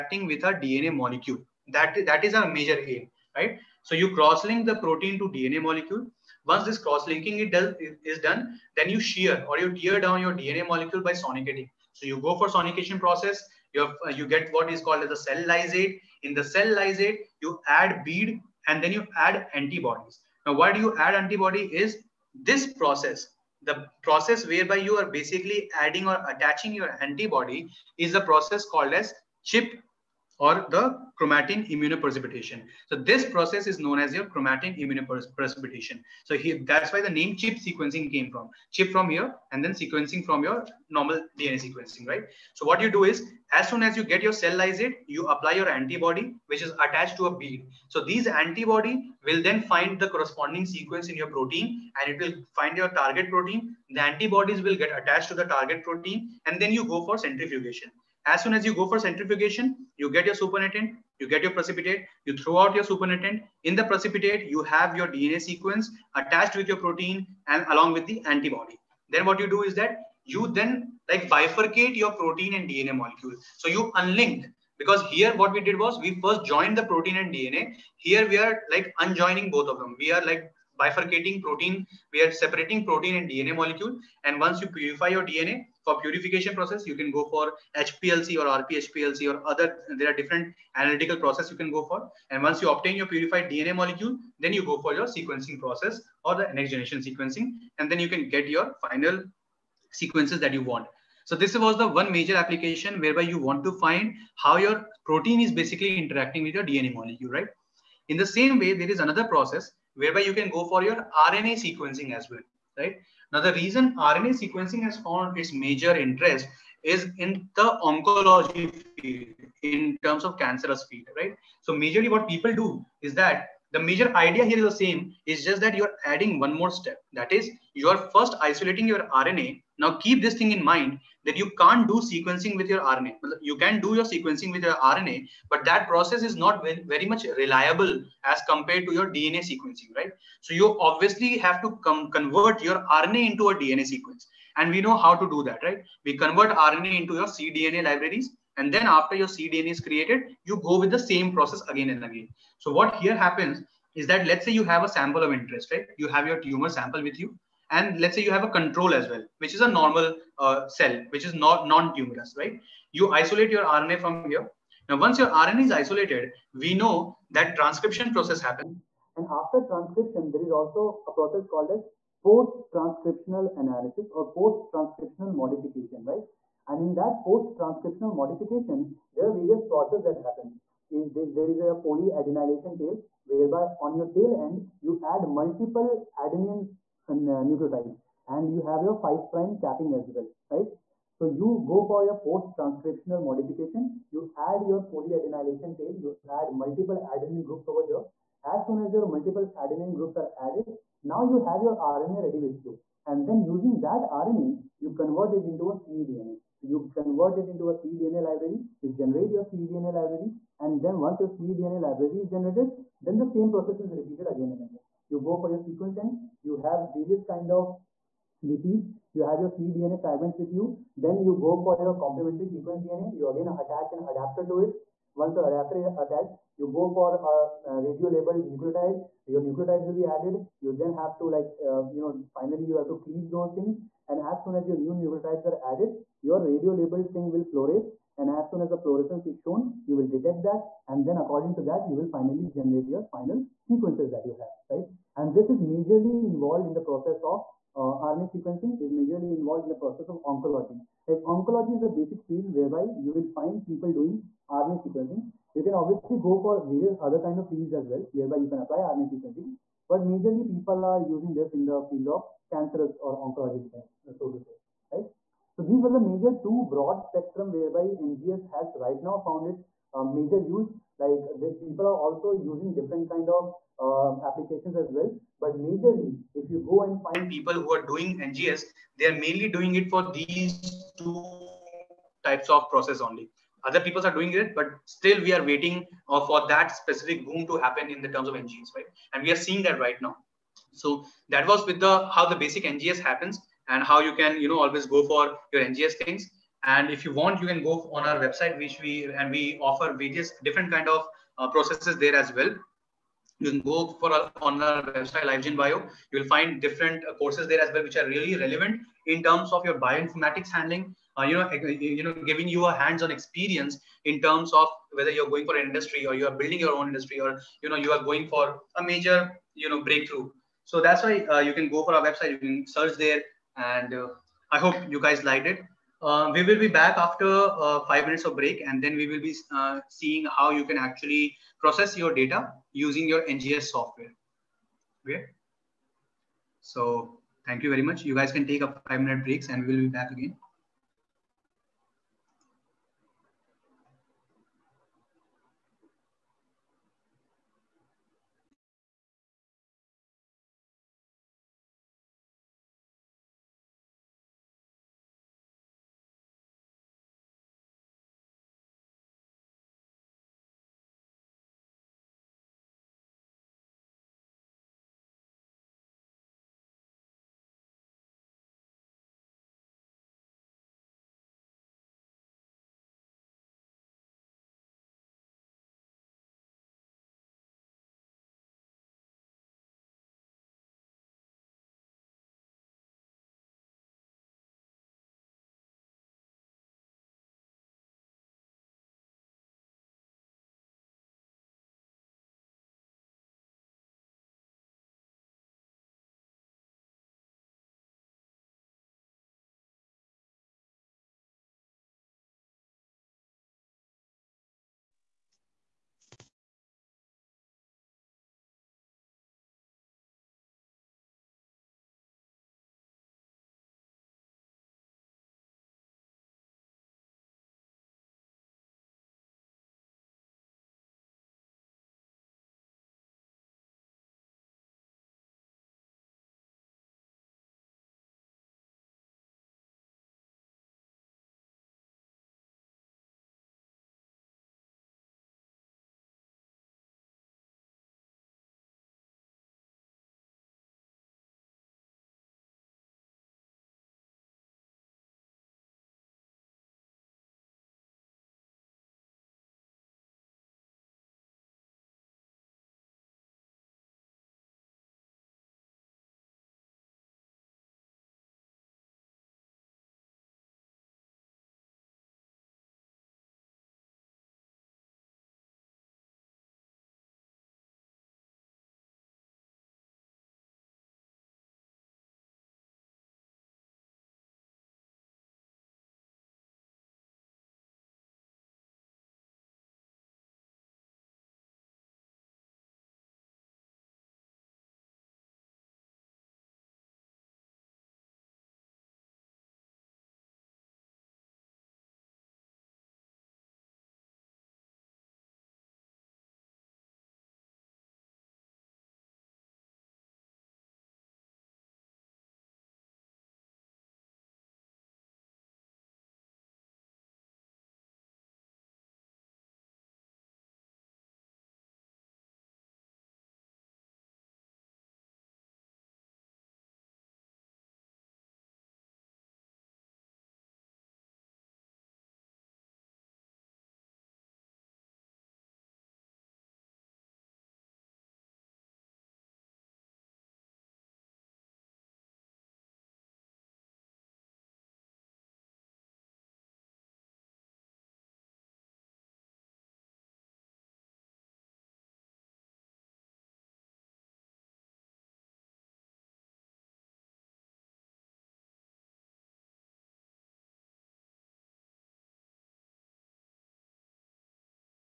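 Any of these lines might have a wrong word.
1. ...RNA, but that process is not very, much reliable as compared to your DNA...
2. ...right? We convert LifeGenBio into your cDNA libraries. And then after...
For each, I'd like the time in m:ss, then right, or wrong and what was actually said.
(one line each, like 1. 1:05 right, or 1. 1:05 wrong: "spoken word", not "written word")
1. 2:14 right
2. 2:25 wrong: "RNA", not "LifeGenBio".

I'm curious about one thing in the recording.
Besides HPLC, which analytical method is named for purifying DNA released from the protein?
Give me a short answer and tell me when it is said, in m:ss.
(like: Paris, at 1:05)
RP-HPLC, at 1:28.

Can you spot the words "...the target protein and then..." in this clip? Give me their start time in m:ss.
0:55.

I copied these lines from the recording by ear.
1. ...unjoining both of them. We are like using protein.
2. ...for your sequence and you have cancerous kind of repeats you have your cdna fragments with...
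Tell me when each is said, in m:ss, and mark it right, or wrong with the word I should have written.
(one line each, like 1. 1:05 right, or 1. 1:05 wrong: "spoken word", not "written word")
1. 1:18 wrong: "bifurcating", not "using"
2. 3:35 wrong: "various", not "cancerous".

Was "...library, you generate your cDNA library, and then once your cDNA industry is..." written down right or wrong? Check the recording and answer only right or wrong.
wrong.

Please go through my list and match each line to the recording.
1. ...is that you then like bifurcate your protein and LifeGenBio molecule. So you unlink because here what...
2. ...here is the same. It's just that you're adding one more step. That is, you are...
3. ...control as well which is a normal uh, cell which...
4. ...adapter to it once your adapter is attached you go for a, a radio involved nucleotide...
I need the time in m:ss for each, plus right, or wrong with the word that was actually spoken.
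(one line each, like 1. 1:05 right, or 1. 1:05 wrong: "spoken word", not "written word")
1. 1:09 wrong: "DNA", not "LifeGenBio"
2. 2:04 right
3. 2:38 right
4. 3:44 wrong: "labeled", not "involved".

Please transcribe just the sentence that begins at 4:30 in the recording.
Like people are also using different kind of uh, applications as well.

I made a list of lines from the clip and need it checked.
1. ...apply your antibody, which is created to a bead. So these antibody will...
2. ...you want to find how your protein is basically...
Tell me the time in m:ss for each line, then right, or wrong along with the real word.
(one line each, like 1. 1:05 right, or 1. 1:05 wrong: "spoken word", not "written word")
1. 0:45 wrong: "attached", not "created"
2. 1:43 right.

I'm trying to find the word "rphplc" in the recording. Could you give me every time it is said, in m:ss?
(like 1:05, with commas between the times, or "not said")
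1:28.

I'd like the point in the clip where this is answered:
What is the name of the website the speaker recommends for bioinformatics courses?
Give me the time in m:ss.
5:05.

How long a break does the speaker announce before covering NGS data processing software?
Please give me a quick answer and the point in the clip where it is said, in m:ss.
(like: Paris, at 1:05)
5 minutes, at 5:27.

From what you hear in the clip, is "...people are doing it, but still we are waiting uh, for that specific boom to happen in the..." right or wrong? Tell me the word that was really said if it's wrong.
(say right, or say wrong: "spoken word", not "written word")
right.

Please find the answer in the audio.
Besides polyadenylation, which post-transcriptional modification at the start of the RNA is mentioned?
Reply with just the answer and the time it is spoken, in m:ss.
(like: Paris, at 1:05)
5 prime capping, at 3:08.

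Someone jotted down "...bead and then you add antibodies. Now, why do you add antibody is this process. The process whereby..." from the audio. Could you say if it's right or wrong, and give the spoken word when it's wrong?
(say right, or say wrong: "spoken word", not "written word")
right.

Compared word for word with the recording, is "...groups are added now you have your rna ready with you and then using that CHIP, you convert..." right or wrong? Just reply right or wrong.
wrong.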